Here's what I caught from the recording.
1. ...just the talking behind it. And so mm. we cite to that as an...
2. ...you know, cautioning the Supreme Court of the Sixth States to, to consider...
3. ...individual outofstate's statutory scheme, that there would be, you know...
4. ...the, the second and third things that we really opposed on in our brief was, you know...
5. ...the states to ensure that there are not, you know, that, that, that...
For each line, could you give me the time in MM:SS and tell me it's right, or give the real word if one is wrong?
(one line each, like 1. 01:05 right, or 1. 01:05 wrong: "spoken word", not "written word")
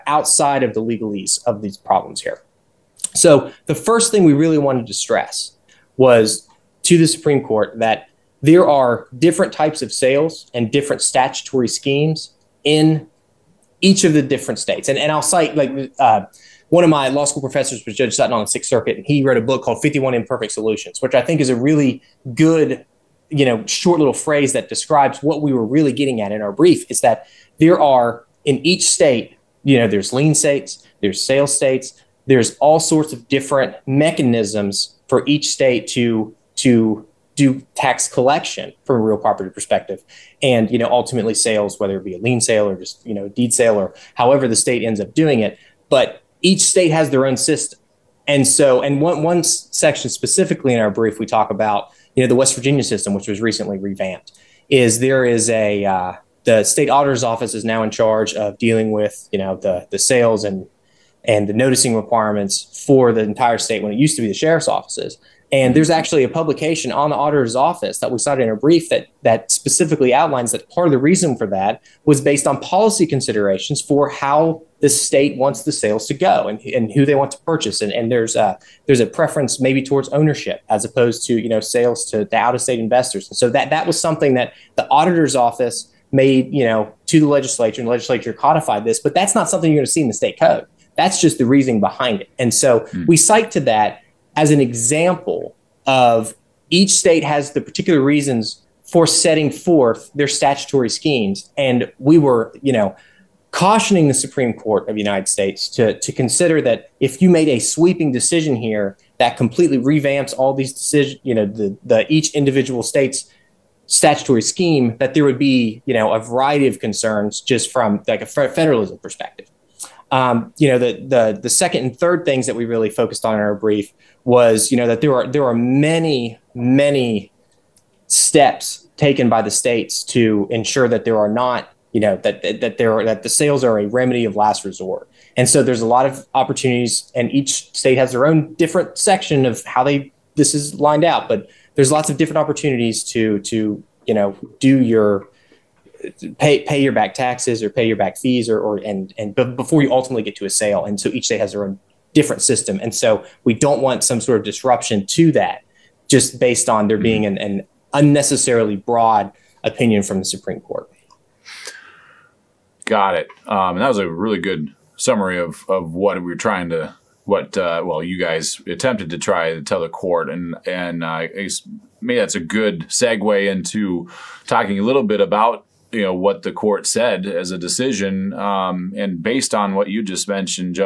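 1. 01:31 wrong: "reasoning", not "talking"
2. 01:42 wrong: "United", not "Sixth"
3. 01:52 wrong: "state", not "outofstate"
4. 02:01 wrong: "focused", not "opposed"
5. 02:09 right.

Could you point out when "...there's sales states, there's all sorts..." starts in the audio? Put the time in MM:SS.
00:31.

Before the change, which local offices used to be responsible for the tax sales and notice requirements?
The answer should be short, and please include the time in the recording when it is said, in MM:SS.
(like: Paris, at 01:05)
Sheriff's offices, at 01:04.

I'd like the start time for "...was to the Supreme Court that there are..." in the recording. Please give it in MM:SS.
00:05.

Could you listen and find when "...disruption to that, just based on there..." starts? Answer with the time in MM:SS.
02:34.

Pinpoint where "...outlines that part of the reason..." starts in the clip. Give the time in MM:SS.
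01:10.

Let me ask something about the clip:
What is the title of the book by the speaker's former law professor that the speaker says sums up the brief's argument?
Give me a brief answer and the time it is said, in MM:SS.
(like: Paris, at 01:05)
51 Imperfect Solutions, at 00:19.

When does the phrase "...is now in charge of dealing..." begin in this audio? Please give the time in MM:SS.
00:57.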